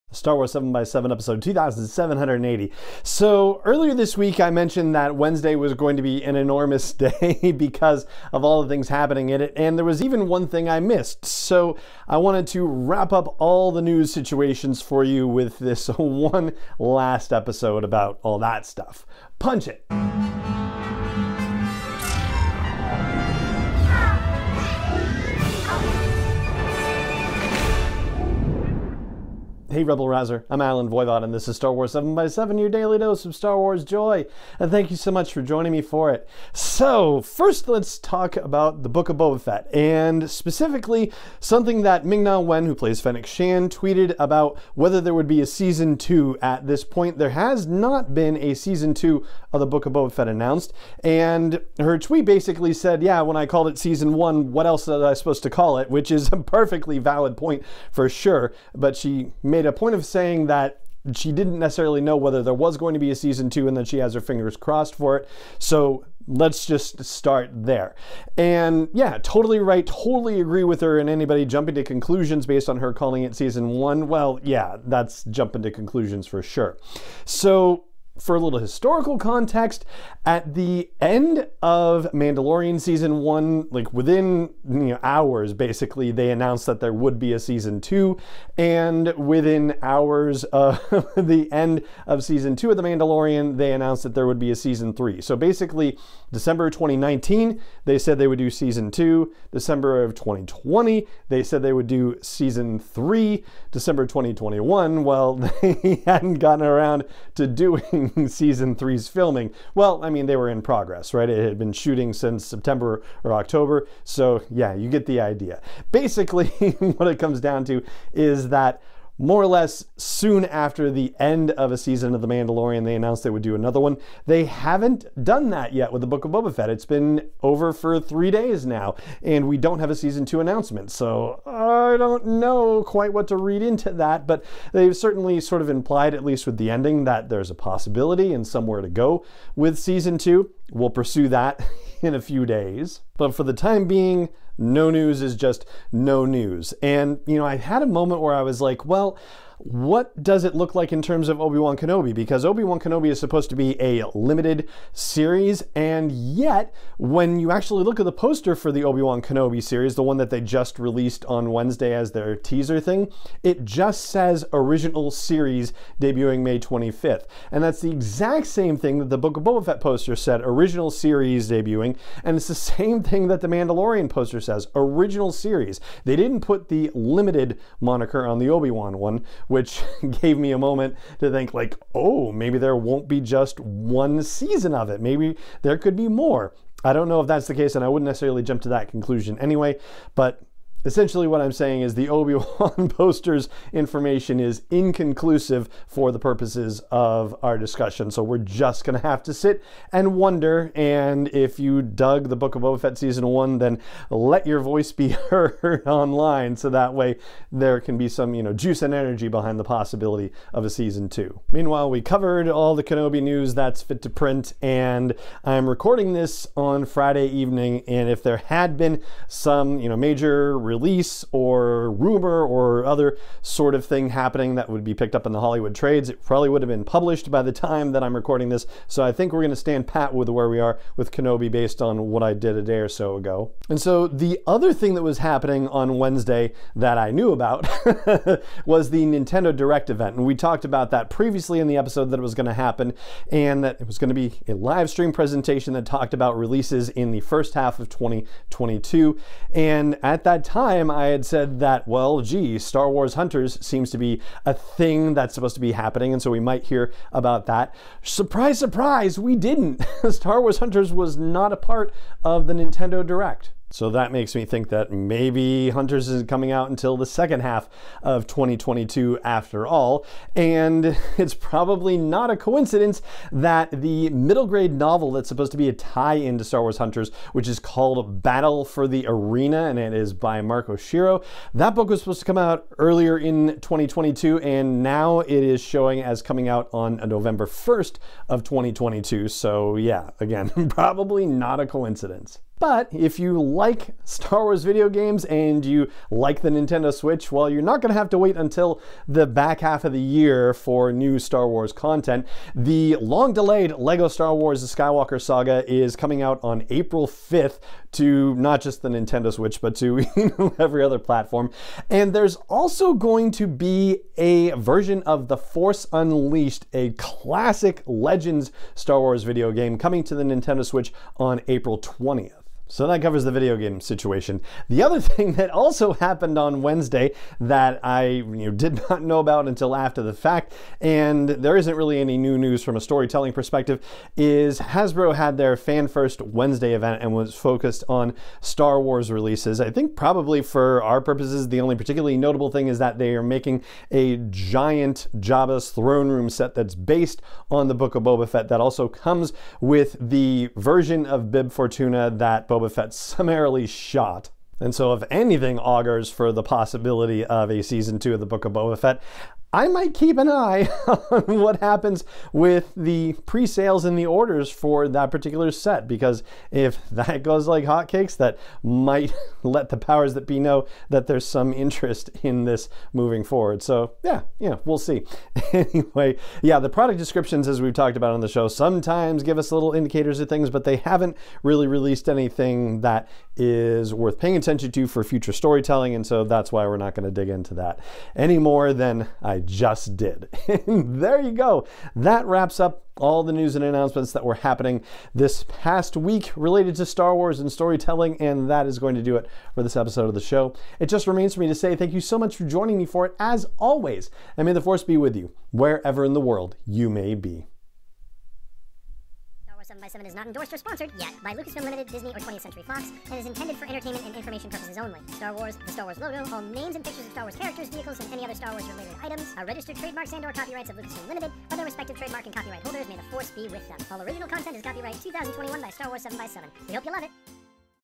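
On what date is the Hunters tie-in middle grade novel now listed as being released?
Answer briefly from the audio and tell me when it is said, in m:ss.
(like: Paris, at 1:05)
November 1st, 2022, at 4:47.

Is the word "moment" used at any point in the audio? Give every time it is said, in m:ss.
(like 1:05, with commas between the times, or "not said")
2:27, 3:00.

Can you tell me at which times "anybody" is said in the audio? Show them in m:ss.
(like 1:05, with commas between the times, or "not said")
1:11.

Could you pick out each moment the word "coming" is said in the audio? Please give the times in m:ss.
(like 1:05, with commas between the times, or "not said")
4:26, 4:46, 5:05, 5:19.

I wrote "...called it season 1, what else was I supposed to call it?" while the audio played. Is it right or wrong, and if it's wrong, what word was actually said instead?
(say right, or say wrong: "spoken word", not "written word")
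right.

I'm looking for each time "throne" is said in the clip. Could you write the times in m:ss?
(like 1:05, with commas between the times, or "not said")
5:45.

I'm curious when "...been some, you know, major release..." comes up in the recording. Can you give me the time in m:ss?
3:38.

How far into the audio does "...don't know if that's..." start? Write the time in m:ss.
3:06.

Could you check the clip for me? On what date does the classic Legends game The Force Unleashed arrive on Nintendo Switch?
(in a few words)
April 20th.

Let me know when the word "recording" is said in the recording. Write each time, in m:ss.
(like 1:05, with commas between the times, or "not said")
3:35, 3:48.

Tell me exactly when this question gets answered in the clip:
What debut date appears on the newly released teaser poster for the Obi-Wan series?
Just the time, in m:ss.
2:46.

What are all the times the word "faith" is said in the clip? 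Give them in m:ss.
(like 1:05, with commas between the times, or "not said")
not said.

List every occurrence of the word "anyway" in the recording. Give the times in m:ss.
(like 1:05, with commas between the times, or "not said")
3:09, 6:15.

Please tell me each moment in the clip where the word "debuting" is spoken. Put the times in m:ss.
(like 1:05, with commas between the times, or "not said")
2:46, 2:51.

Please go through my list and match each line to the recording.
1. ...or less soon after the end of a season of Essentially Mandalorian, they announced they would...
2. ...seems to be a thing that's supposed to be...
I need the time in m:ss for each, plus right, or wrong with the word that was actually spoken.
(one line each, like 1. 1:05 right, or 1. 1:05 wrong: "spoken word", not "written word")
1. 1:59 wrong: "The", not "Essentially"
2. 4:13 right.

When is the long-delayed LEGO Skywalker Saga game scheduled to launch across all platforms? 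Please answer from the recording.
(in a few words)
April 5th.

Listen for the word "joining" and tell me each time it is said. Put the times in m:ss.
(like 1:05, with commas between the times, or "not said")
0:35, 6:42.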